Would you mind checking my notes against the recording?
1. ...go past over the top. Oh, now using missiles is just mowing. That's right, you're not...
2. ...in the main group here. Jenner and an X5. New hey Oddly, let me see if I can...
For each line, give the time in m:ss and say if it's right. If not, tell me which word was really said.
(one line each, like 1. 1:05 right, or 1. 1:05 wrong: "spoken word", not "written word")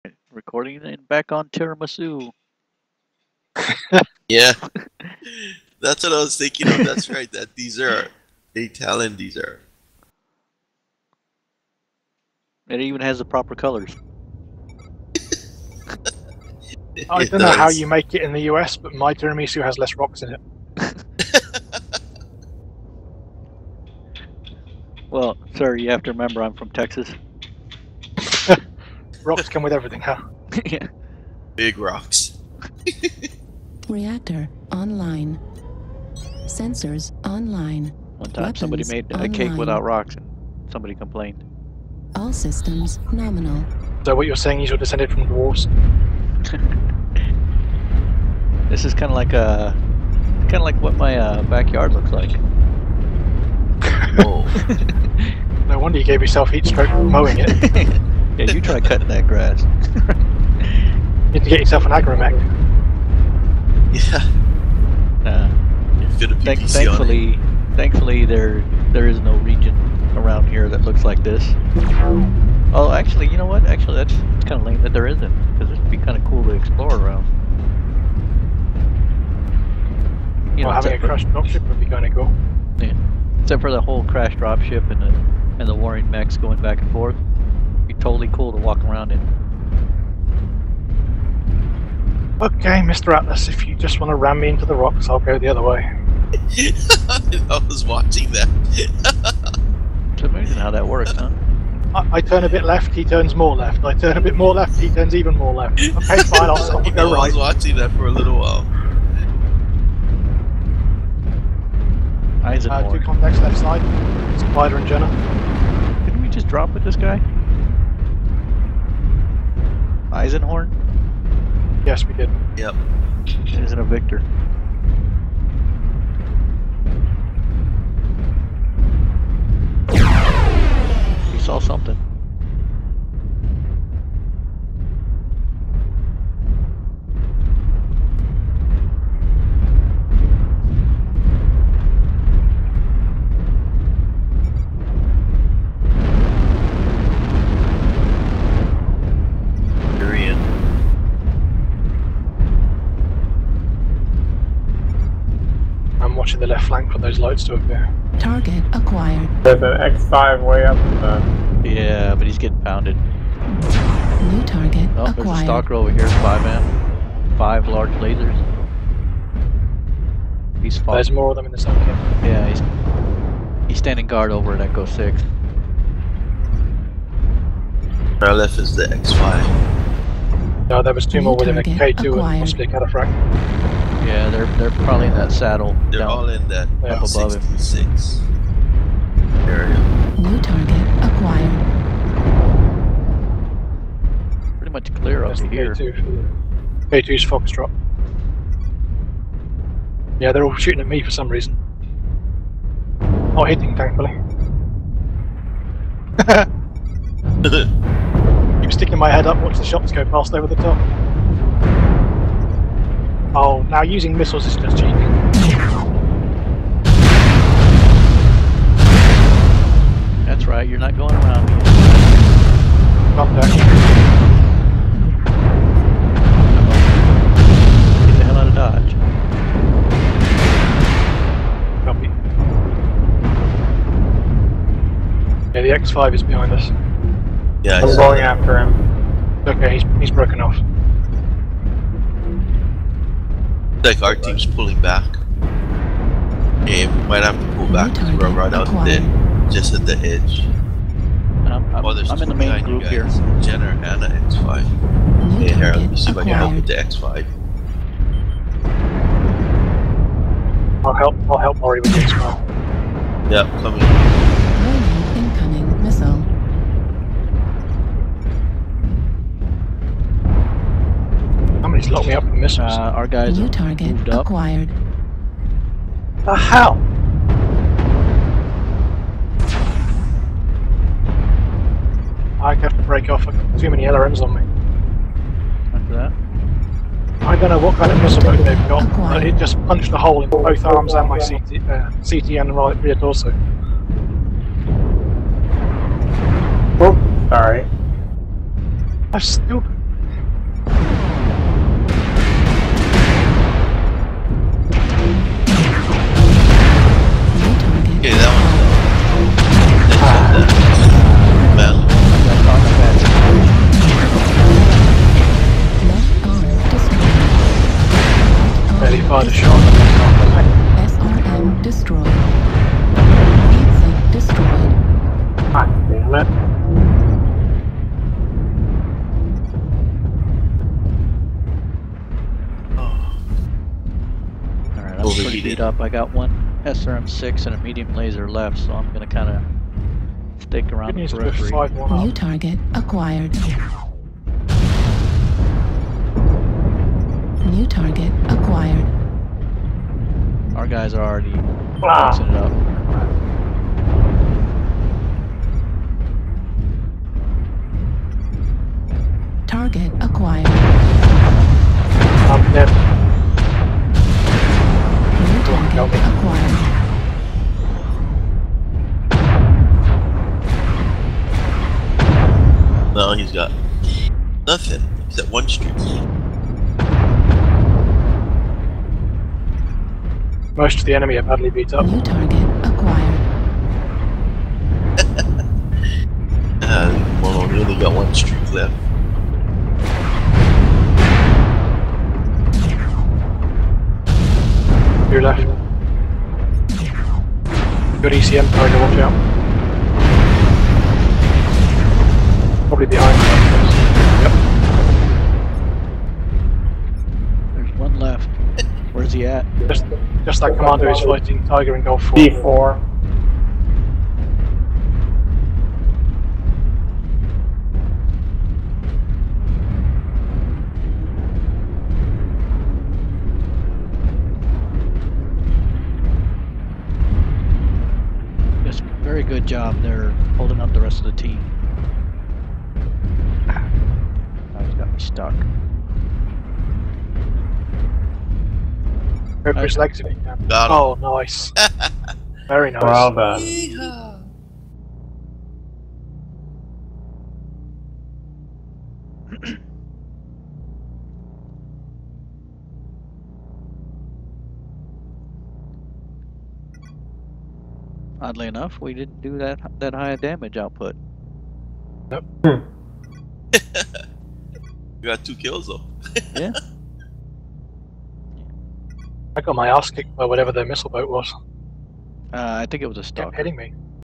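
1. 3:29 wrong: "cheating", not "mowing"
2. 4:12 wrong: "Harold", not "Oddly".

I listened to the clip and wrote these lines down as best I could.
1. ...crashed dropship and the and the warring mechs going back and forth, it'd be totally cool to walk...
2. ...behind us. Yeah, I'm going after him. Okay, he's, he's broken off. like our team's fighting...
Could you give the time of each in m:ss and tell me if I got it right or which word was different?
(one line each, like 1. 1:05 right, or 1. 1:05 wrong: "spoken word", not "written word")
1. 1:24 right
2. 3:56 wrong: "pulling", not "fighting".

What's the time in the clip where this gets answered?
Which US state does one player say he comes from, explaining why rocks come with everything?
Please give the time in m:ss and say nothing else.
0:26.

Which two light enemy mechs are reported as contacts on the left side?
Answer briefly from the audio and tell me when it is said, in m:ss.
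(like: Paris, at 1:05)
Spider and Jenner, at 1:54.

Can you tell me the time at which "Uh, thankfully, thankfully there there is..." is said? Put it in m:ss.
1:05.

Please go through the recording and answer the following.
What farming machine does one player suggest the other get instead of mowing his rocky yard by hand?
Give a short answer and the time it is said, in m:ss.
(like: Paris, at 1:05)
AgroMech, at 1:01.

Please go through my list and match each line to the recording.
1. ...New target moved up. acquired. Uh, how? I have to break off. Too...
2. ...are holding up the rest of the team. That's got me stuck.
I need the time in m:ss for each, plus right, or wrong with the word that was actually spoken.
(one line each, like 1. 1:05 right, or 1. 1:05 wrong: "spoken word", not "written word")
1. 4:33 right
2. 7:09 right.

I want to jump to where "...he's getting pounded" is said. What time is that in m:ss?
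2:42.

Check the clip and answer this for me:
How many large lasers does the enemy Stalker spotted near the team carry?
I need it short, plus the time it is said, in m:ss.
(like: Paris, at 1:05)
5, at 2:47.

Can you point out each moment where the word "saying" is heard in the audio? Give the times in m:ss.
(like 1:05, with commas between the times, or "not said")
0:44.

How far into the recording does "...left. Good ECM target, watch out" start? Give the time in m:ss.
6:35.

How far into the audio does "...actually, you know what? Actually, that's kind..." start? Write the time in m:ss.
1:12.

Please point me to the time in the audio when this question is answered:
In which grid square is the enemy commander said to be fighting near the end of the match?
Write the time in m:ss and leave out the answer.
6:52.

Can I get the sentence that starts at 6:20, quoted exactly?
Most of the enemy have badly beat up.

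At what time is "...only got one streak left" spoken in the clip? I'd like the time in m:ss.
6:27.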